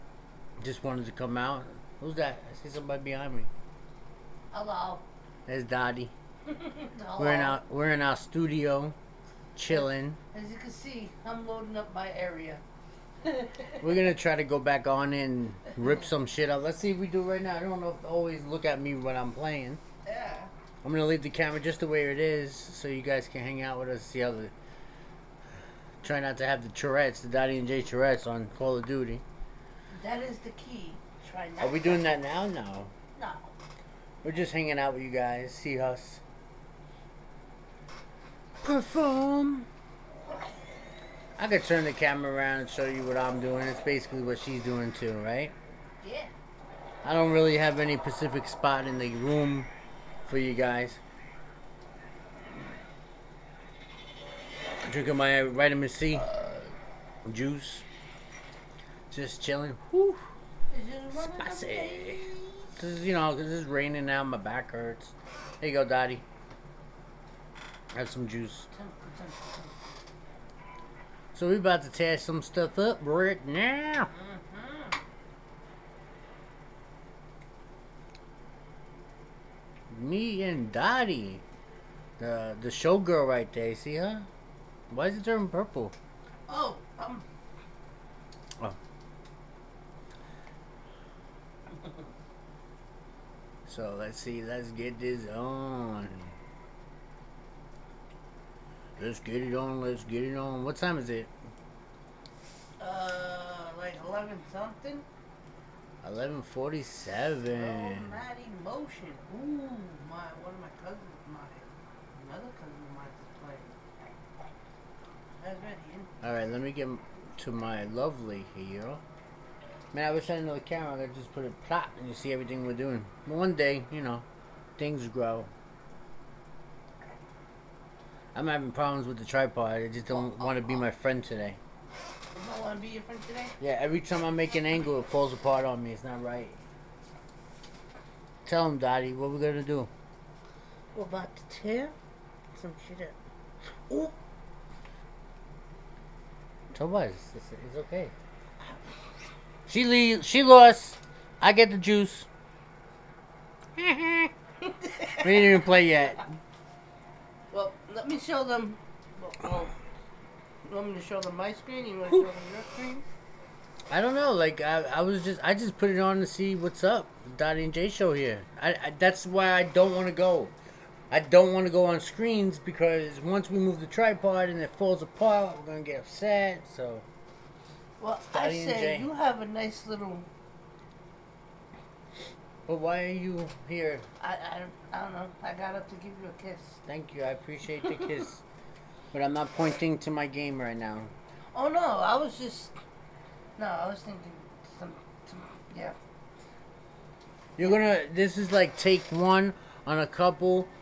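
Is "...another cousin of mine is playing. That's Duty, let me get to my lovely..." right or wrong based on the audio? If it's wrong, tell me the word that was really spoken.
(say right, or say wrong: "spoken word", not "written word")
wrong: "Alright", not "Duty".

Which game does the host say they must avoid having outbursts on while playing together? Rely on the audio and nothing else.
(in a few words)
Call of Duty.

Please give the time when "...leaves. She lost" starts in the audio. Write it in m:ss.
2:29.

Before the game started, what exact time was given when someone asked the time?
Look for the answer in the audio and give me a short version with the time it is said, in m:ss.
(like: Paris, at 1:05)
11:47, at 1:46.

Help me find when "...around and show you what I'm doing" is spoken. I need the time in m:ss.
0:42.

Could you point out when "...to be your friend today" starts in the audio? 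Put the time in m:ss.
2:12.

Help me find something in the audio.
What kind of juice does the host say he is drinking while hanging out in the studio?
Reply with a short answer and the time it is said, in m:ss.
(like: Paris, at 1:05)
vitamin C, at 0:55.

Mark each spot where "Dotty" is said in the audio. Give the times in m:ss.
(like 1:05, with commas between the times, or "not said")
0:05, 0:27, 1:20, 2:47, 2:58.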